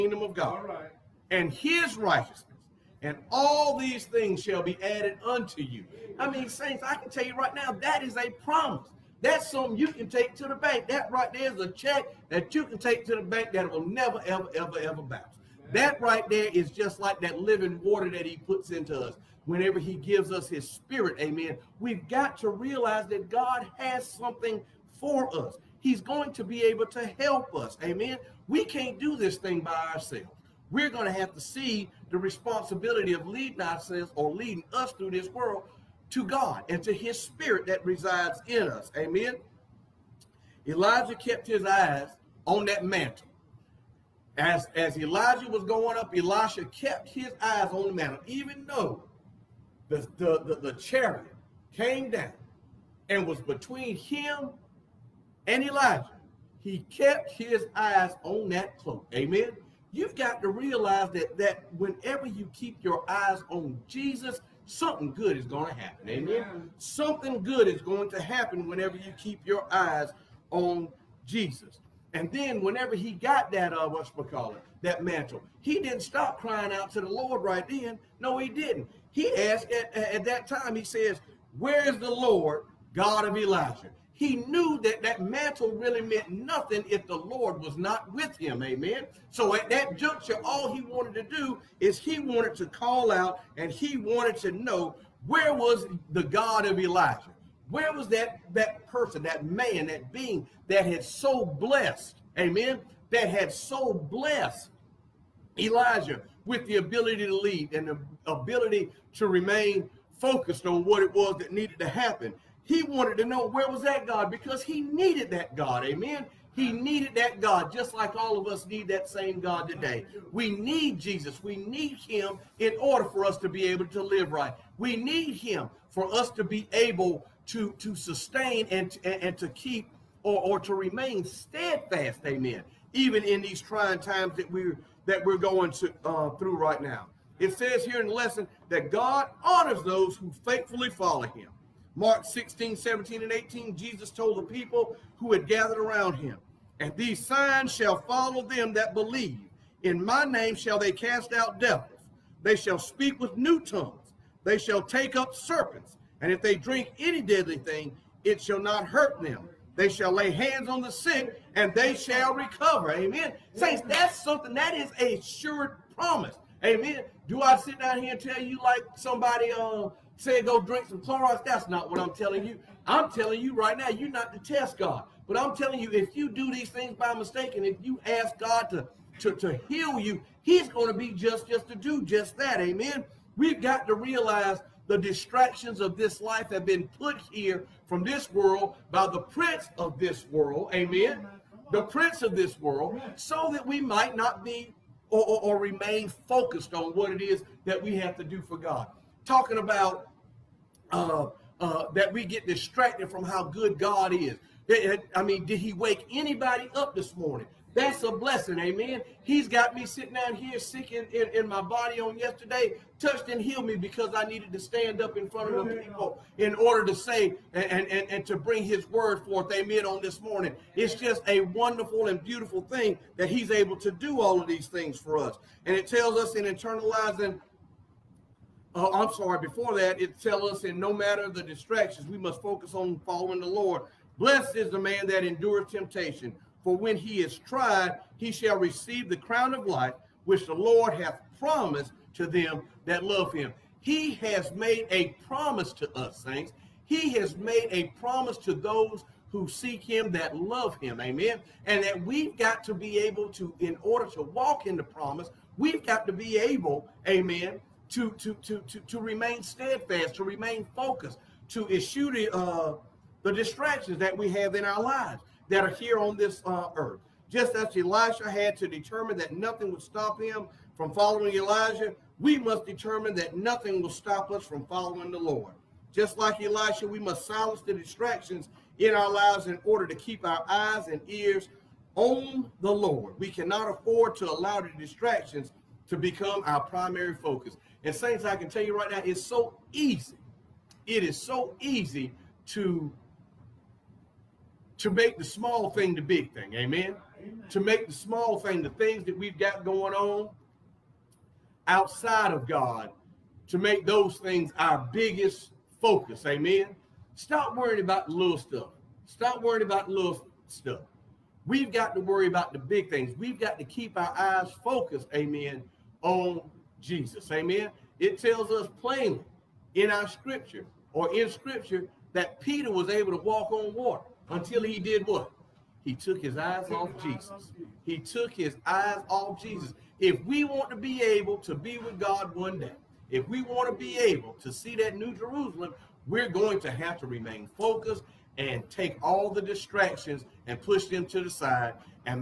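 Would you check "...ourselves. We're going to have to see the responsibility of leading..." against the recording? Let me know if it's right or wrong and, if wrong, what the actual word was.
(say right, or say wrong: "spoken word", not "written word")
right.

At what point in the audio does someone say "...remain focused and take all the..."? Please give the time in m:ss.
5:37.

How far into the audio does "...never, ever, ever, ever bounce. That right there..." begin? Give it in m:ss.
0:13.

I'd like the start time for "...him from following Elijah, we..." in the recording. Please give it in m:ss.
4:30.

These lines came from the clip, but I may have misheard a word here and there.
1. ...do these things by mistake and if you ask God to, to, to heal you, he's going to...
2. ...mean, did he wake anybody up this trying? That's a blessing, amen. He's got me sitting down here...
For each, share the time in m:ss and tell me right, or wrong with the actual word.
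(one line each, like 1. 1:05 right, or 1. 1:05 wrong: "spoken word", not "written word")
1. 2:56 right
2. 3:25 wrong: "morning", not "trying".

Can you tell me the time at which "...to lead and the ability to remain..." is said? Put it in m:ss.
1:47.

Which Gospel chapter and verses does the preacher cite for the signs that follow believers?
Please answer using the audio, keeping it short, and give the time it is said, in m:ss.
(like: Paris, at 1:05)
Mark 16, 17, and 18, at 2:21.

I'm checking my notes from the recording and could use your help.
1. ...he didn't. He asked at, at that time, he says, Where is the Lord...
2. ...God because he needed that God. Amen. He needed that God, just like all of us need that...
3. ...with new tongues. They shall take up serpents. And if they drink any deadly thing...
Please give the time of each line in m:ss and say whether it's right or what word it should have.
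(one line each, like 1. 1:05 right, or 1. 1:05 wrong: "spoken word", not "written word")
1. 1:18 right
2. 1:54 right
3. 2:33 right.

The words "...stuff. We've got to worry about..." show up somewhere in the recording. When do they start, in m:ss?
5:10.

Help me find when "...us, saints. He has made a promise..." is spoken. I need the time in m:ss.
4:05.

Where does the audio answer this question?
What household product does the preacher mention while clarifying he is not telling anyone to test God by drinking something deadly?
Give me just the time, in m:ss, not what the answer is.
2:51.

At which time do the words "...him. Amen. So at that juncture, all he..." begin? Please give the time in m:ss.
1:28.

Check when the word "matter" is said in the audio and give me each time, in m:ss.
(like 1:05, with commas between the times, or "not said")
3:50.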